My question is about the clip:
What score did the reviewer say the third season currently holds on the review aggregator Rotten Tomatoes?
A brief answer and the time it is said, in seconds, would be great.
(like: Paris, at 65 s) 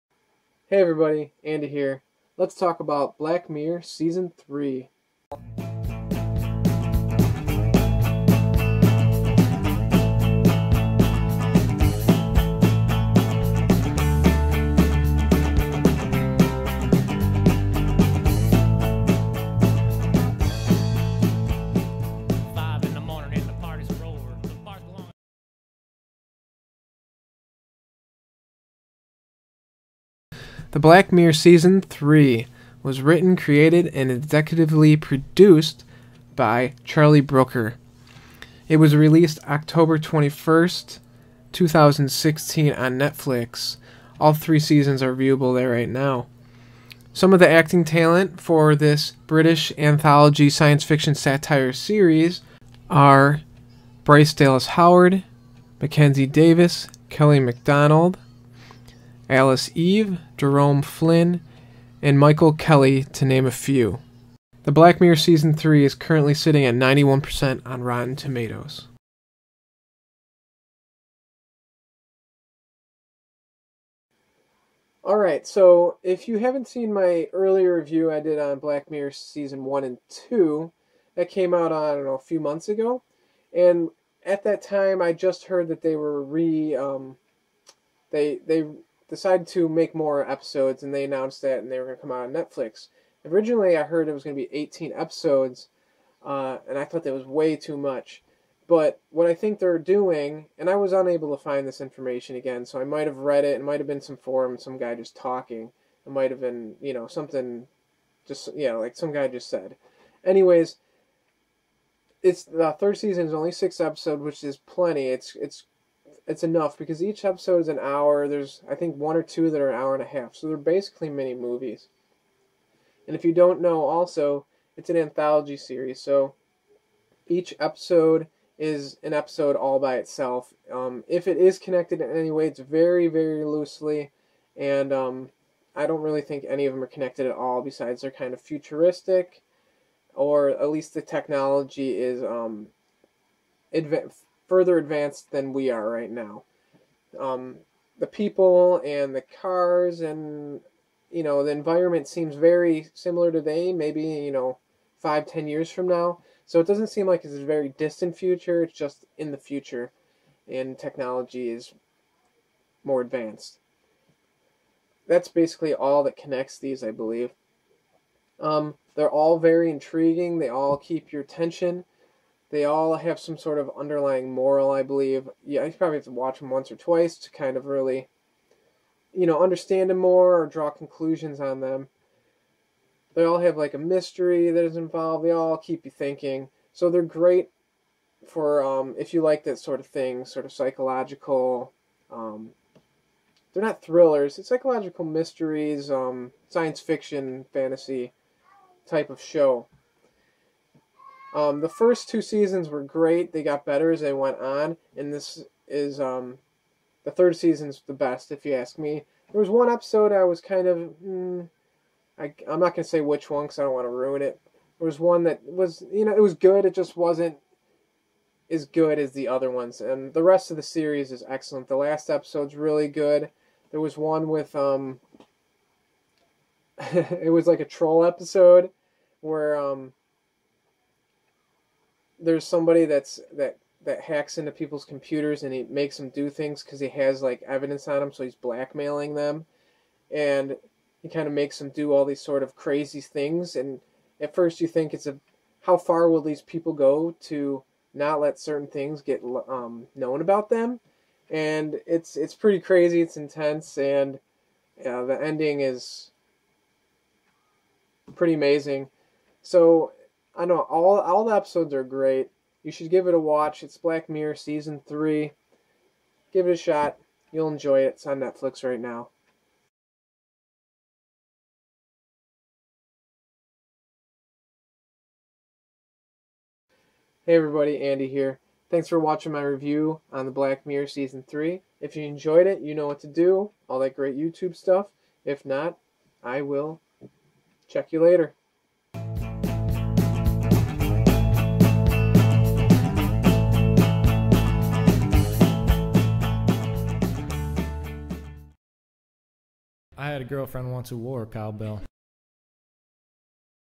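91%, at 66 s.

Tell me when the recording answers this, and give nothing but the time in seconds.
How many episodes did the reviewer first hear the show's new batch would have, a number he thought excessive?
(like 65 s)
94 s.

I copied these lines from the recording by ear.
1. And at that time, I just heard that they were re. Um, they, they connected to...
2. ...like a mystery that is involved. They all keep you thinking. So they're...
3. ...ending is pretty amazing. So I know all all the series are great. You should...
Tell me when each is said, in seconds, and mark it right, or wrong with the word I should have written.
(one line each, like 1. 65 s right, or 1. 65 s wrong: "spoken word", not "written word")
1. 83 s wrong: "decided", not "connected"
2. 183 s right
3. 255 s wrong: "episodes", not "series".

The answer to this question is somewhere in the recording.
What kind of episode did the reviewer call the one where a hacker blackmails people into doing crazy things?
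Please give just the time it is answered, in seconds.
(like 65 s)
227 s.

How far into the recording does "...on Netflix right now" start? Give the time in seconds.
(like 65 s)
268 s.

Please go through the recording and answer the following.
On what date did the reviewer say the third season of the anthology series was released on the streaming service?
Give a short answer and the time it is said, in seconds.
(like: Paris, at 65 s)
October 21st, 2016, at 39 s.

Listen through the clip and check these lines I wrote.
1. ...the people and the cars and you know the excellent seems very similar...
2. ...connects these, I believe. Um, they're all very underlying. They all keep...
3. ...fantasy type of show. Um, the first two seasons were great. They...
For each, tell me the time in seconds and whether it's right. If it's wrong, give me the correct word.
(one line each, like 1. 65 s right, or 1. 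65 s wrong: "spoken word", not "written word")
1. 147 s wrong: "environment", not "excellent"
2. 166 s wrong: "intriguing", not "underlying"
3. 197 s right.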